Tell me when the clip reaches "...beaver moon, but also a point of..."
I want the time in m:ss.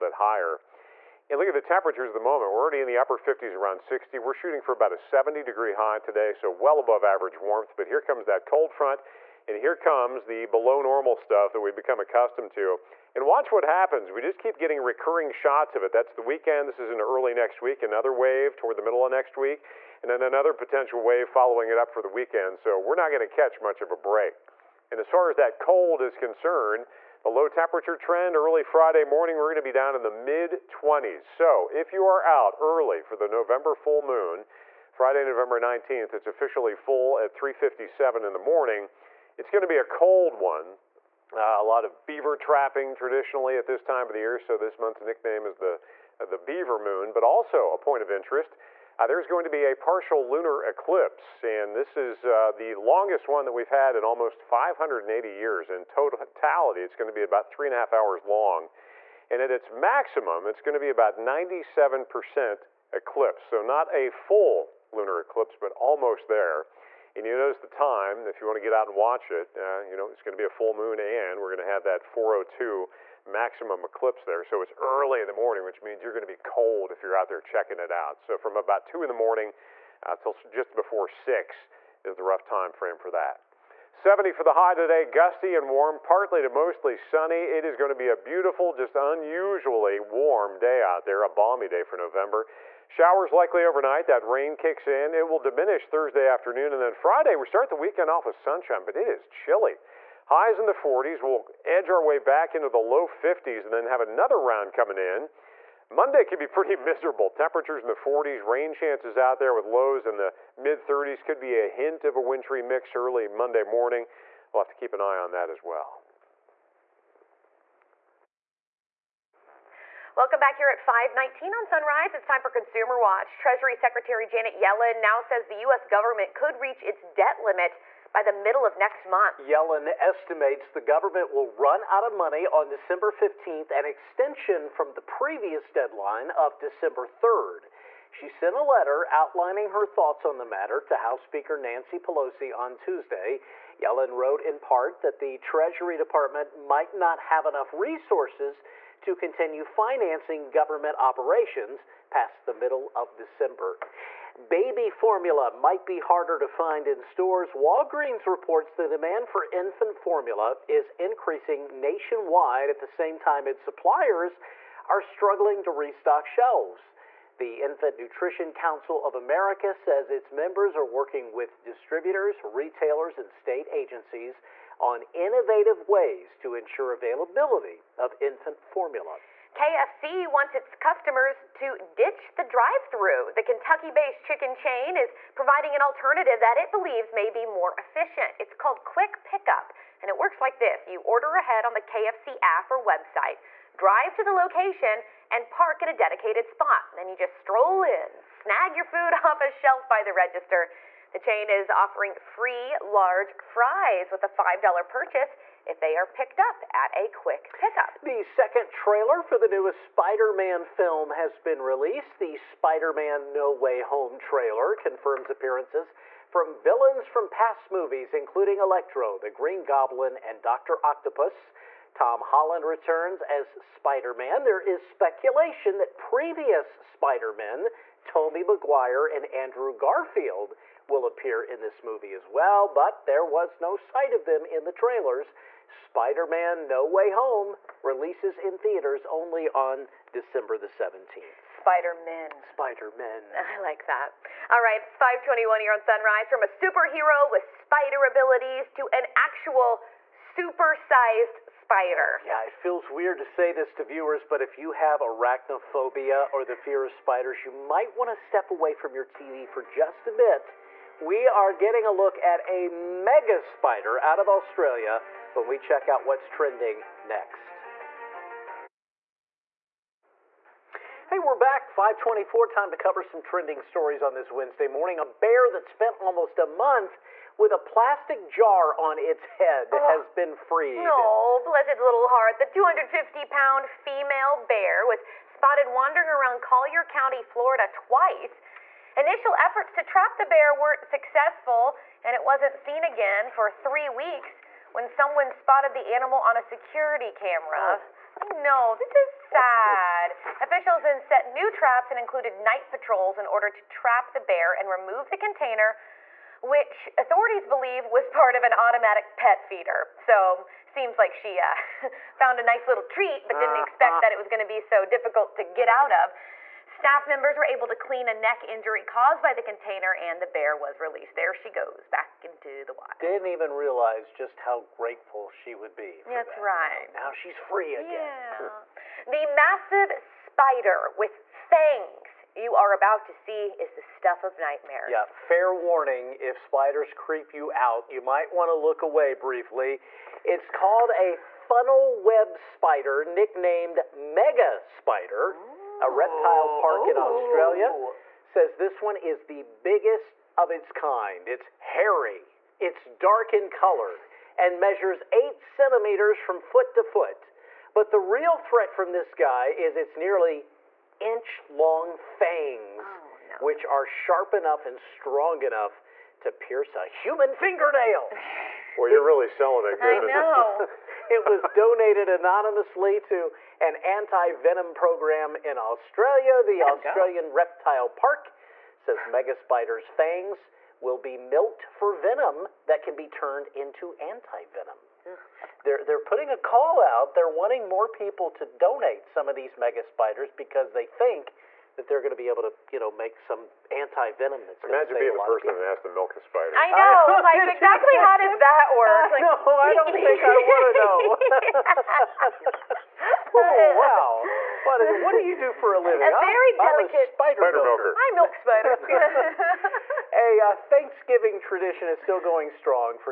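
0:46.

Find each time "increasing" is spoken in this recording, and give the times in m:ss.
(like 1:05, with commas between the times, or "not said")
2:40.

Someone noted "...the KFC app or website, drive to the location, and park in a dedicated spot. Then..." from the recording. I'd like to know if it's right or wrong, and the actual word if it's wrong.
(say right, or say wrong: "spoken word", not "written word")
right.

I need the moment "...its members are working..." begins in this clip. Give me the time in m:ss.
2:50.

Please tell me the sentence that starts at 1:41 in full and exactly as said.
We'll edge our way back into the low 50s and then have another round coming in.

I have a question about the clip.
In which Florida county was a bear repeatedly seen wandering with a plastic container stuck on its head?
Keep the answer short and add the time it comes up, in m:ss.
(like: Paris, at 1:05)
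Collier County, at 4:46.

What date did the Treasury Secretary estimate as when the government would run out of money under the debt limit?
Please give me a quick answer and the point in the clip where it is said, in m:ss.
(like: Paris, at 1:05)
December 15th, at 2:12.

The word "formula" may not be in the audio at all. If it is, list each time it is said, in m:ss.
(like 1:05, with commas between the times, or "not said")
2:34, 2:39, 2:58.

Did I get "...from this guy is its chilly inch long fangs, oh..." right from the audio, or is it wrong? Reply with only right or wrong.
wrong.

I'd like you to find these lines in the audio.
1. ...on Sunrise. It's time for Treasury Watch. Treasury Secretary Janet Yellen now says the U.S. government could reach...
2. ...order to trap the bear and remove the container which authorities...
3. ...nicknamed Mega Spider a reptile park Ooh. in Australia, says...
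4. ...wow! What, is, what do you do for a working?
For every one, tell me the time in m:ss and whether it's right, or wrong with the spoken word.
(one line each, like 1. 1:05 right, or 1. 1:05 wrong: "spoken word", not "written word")
1. 2:01 wrong: "Consumer", not "Treasury"
2. 5:03 right
3. 5:43 right
4. 6:43 wrong: "living", not "working".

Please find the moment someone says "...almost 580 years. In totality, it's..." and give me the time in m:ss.
0:54.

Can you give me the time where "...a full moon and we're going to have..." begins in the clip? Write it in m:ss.
1:10.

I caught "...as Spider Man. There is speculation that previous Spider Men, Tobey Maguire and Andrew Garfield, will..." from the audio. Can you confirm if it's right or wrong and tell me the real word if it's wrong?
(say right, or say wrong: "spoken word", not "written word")
right.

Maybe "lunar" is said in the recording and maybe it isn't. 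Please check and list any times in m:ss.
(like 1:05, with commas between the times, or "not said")
0:50, 1:04.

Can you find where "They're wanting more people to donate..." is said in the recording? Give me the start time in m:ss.
6:27.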